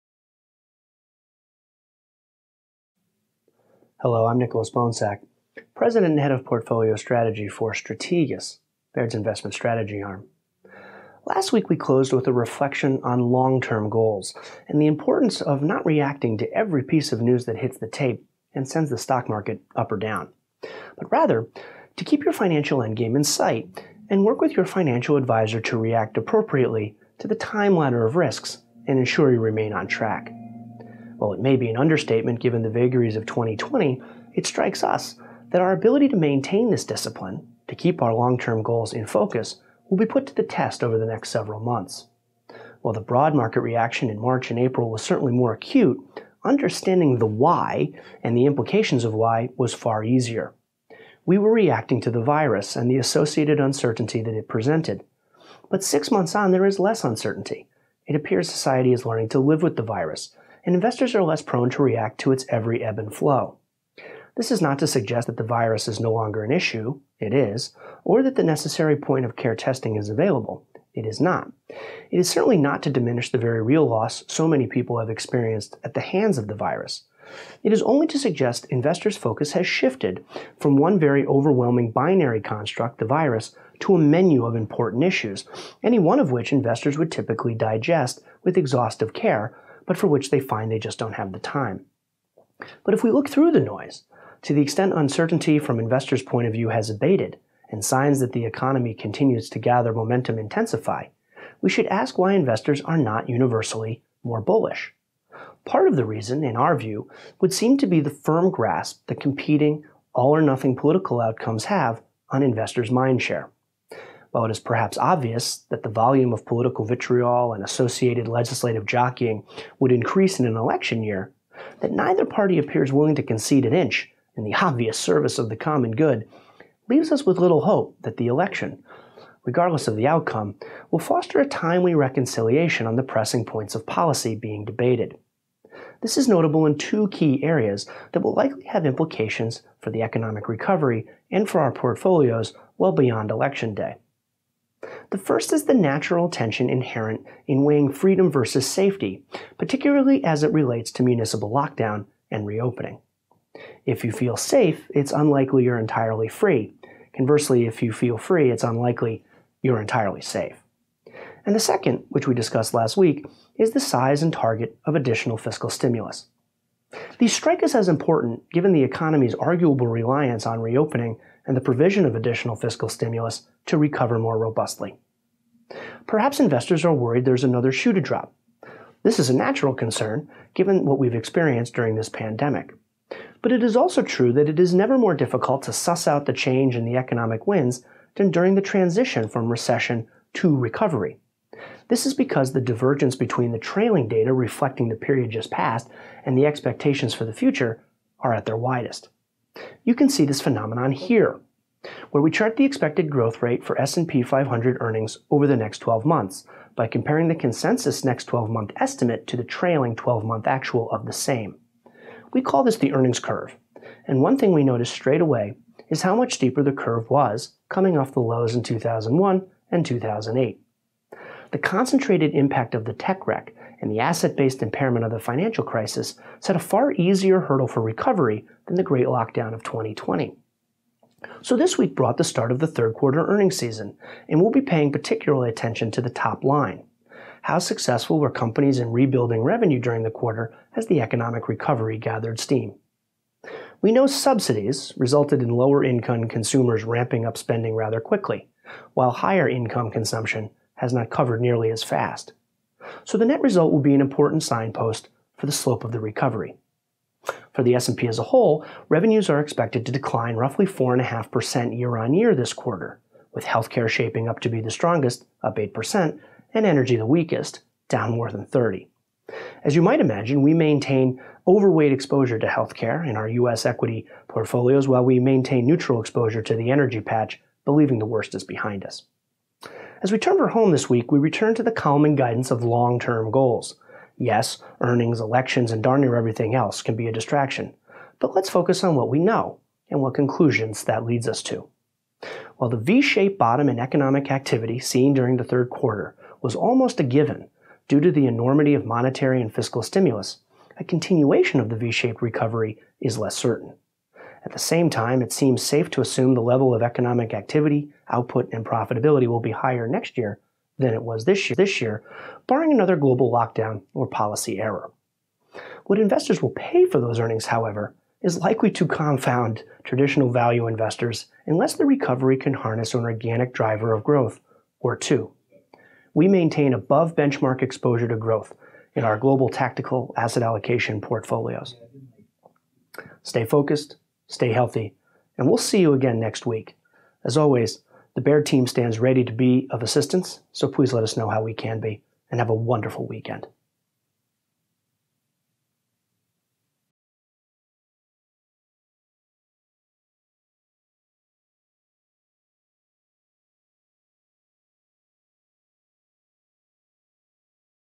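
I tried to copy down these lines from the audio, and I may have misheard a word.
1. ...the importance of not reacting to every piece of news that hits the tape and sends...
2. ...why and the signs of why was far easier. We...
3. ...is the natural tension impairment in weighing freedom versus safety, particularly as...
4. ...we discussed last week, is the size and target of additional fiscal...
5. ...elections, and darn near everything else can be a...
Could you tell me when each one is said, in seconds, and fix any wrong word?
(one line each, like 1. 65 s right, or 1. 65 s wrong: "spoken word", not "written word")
1. 14 s right
2. 47 s wrong: "implications", not "signs"
3. 145 s wrong: "inherent", not "impairment"
4. 162 s right
5. 285 s right.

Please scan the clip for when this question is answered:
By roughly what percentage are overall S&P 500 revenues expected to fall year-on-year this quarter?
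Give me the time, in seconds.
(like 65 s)
260 s.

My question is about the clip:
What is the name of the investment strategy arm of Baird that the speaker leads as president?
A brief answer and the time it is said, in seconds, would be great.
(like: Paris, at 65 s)
Strategas, at 7 s.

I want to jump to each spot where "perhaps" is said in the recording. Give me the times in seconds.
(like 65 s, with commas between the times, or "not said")
114 s, 176 s.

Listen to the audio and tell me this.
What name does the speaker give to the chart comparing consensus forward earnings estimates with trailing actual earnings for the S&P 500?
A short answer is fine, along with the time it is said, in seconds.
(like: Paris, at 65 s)
the earnings curve, at 212 s.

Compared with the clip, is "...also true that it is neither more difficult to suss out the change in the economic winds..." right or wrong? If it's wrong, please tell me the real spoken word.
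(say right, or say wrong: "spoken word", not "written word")
wrong: "never", not "neither".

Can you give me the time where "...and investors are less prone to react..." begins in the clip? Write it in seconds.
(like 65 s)
60 s.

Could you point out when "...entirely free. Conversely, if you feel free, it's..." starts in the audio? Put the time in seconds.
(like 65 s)
155 s.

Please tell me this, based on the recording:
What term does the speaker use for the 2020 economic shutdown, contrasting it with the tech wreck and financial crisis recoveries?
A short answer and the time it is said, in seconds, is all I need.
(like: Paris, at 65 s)
the Great Lockdown, at 228 s.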